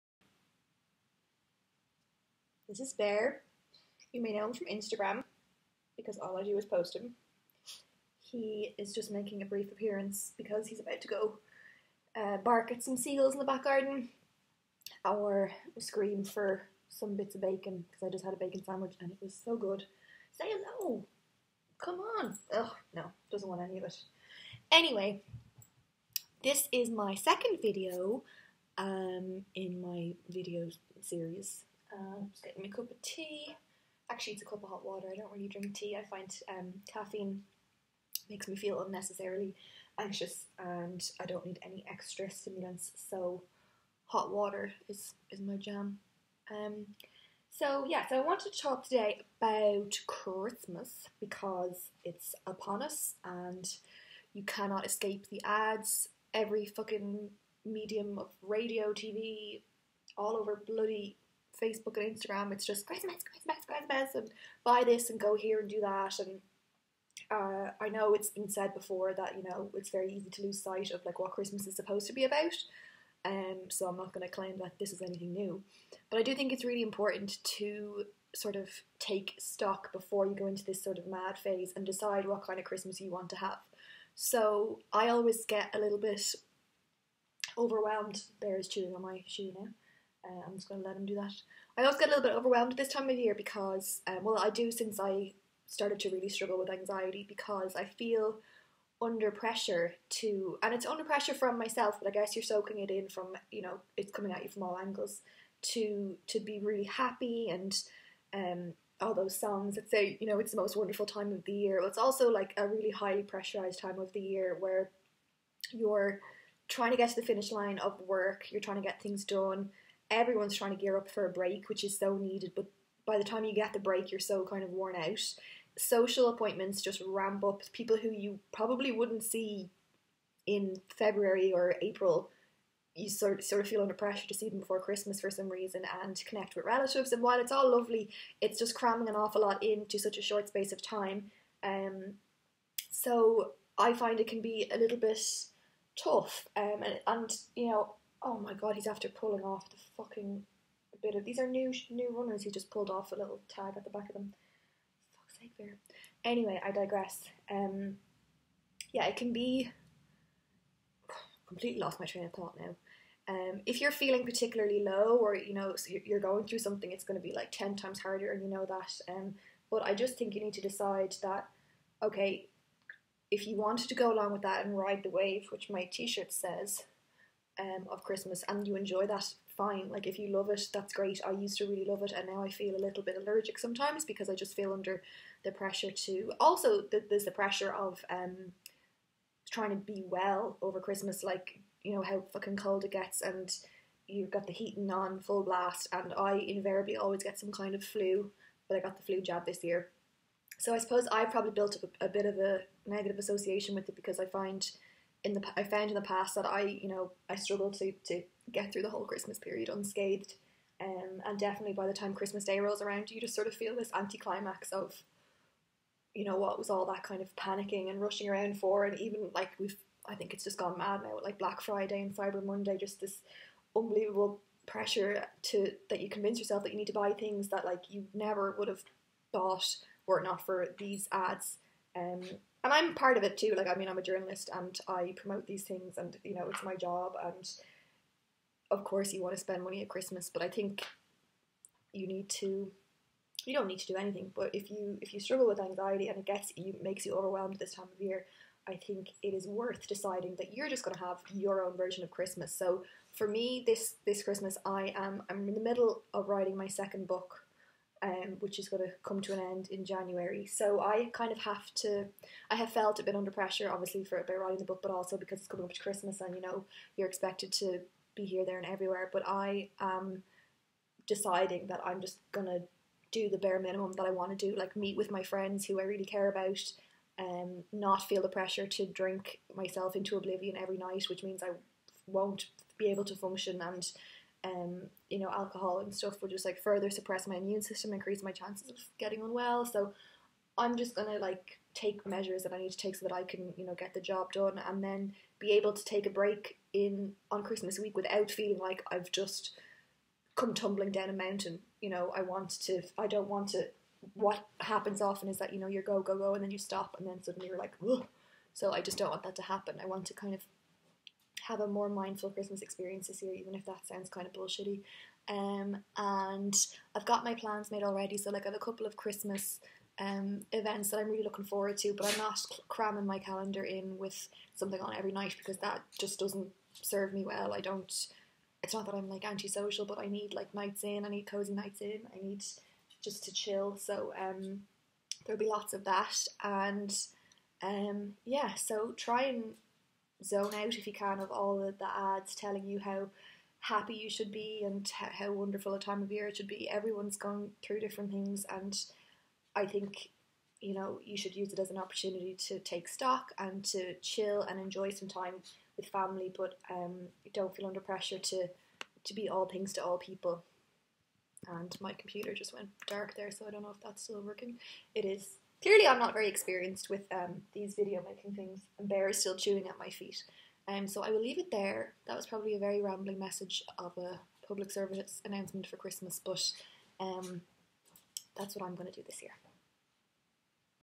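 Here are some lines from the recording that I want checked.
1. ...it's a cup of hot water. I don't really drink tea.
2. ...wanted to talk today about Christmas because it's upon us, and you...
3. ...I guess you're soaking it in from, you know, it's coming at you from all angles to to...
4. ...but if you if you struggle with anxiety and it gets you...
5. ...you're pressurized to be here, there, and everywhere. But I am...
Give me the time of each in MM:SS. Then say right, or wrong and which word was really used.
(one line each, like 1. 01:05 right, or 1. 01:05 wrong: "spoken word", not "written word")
1. 00:34 right
2. 00:48 right
3. 01:42 right
4. 04:04 right
5. 04:26 wrong: "expected", not "pressurized".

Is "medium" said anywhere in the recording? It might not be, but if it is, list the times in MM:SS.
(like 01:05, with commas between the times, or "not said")
00:57.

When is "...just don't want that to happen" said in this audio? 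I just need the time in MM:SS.
05:08.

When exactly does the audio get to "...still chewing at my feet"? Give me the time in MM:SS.
06:09.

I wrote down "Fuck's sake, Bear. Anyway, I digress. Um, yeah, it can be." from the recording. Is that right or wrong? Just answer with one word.
right.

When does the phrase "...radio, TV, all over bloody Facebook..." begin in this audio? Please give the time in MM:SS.
00:58.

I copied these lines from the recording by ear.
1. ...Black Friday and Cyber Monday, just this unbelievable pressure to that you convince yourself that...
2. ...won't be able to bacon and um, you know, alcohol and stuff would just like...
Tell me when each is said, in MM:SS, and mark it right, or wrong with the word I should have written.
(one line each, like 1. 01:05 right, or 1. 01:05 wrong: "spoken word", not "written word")
1. 03:41 right
2. 04:42 wrong: "function", not "bacon".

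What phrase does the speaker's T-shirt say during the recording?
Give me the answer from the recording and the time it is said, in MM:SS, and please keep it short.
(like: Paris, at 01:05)
Ride the wave, at 02:54.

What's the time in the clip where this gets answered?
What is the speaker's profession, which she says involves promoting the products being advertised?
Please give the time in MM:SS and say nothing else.
03:54.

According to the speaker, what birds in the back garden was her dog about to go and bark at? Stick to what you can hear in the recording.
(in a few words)
Seagulls.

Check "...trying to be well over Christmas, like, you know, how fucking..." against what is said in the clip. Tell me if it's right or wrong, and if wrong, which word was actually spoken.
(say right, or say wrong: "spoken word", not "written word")
right.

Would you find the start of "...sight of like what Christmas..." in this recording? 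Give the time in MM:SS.
01:10.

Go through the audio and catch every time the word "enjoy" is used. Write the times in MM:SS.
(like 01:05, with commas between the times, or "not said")
02:58, 05:54.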